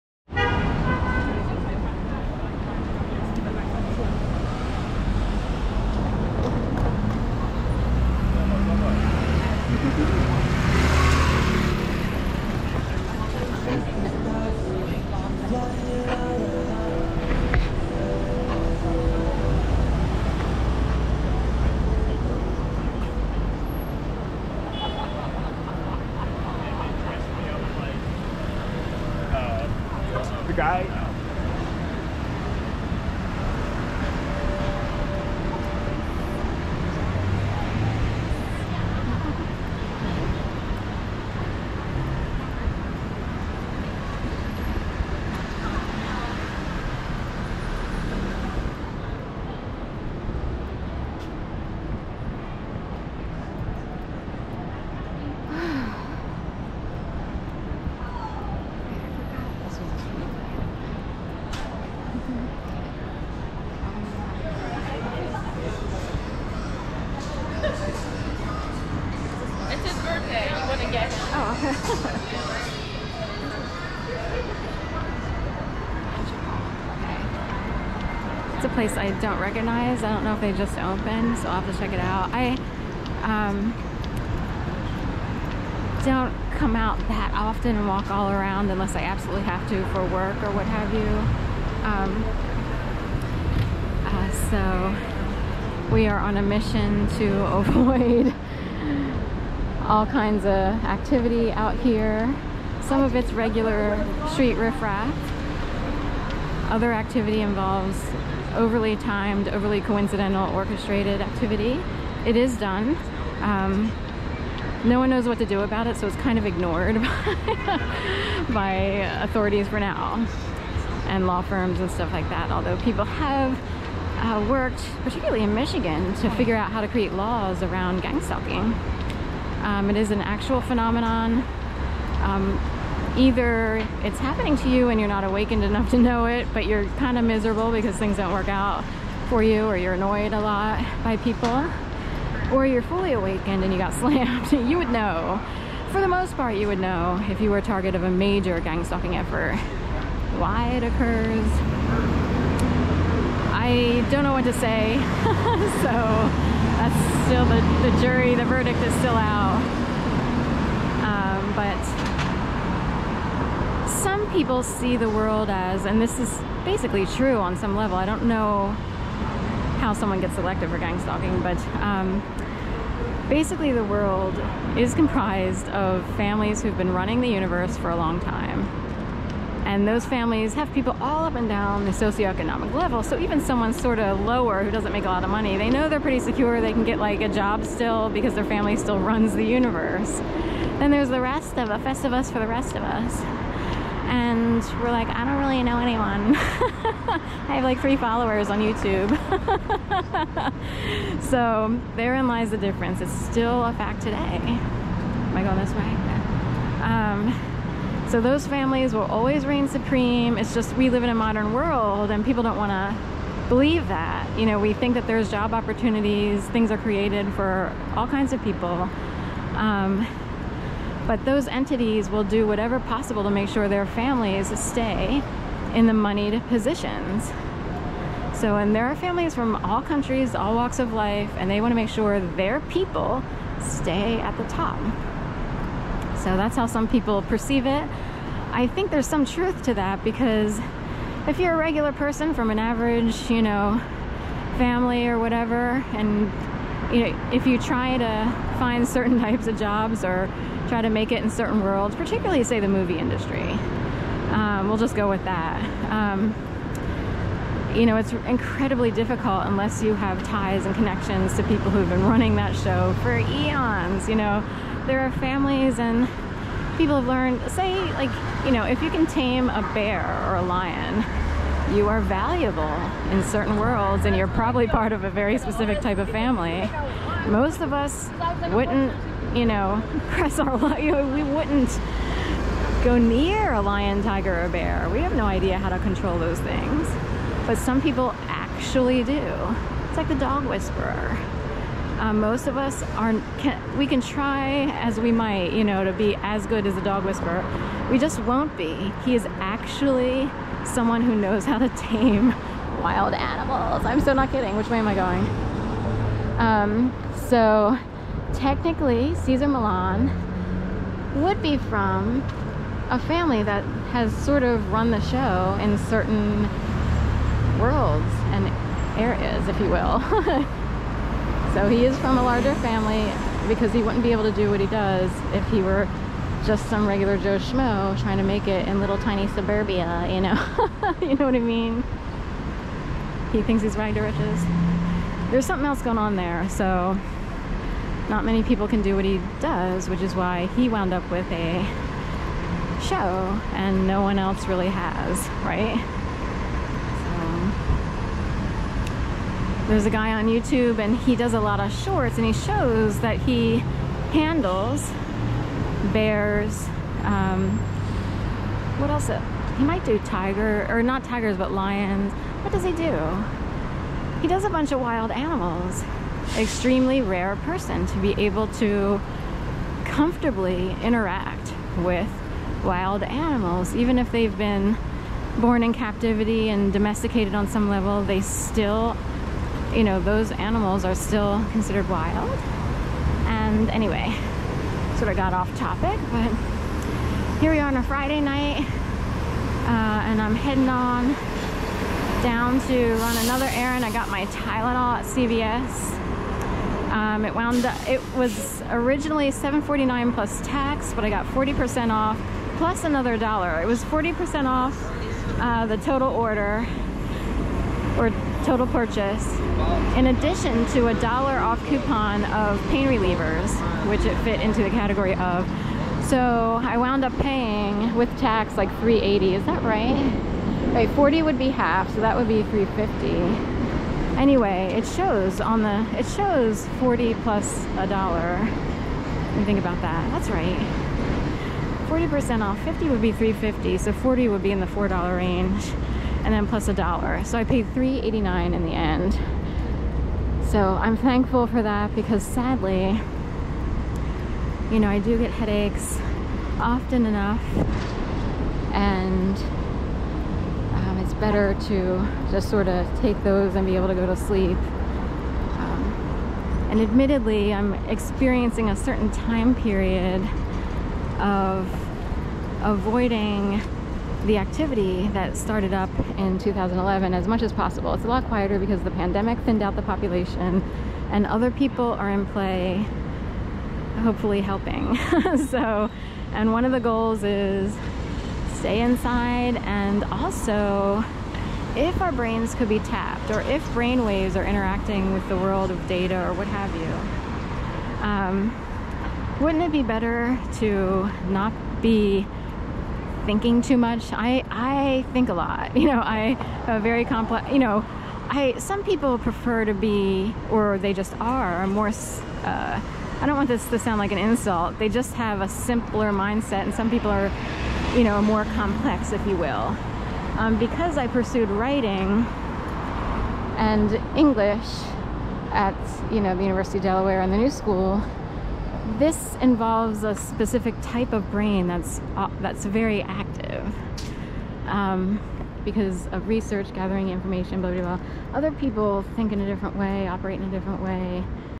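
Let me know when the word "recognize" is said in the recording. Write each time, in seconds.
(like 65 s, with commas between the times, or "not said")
79 s.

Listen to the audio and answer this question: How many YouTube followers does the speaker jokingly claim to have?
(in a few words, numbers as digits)
3.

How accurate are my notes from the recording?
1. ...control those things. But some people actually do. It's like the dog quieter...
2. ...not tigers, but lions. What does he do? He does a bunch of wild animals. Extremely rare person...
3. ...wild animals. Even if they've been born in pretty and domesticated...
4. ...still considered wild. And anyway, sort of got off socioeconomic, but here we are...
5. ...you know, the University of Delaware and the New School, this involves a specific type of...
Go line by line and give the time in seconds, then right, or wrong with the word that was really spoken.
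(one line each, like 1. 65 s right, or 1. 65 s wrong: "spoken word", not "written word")
1. 285 s wrong: "whisperer", not "quieter"
2. 360 s right
3. 372 s wrong: "captivity", not "pretty"
4. 380 s wrong: "topic", not "socioeconomic"
5. 516 s right.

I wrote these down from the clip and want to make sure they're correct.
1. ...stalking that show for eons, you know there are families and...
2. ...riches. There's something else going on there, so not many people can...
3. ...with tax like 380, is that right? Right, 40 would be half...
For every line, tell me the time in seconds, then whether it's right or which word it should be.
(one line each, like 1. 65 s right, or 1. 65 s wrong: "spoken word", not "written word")
1. 262 s wrong: "running", not "stalking"
2. 334 s right
3. 417 s right.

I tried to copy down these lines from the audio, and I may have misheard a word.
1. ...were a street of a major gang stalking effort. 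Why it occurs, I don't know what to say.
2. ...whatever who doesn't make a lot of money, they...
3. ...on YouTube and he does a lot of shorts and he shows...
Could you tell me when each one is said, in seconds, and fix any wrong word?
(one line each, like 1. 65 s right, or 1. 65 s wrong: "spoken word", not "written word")
1. 147 s wrong: "target", not "street"
2. 184 s wrong: "lower", not "whatever"
3. 350 s right.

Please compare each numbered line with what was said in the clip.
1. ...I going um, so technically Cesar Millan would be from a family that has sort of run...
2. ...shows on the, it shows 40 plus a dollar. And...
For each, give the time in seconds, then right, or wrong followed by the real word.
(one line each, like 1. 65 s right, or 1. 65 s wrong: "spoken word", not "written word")
1. 304 s right
2. 424 s right.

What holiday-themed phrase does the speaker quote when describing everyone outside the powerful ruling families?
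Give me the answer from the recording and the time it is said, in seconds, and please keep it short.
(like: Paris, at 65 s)
festivus for the rest of us, at 191 s.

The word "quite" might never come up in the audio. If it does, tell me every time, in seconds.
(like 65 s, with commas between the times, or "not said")
not said.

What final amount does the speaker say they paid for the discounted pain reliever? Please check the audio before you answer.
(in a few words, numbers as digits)
$3.89.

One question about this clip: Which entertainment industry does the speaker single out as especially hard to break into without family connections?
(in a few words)
the movie industry.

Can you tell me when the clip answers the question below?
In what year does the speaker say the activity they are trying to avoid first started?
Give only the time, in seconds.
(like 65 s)
466 s.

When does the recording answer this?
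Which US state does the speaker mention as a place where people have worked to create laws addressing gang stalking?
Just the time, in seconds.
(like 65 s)
125 s.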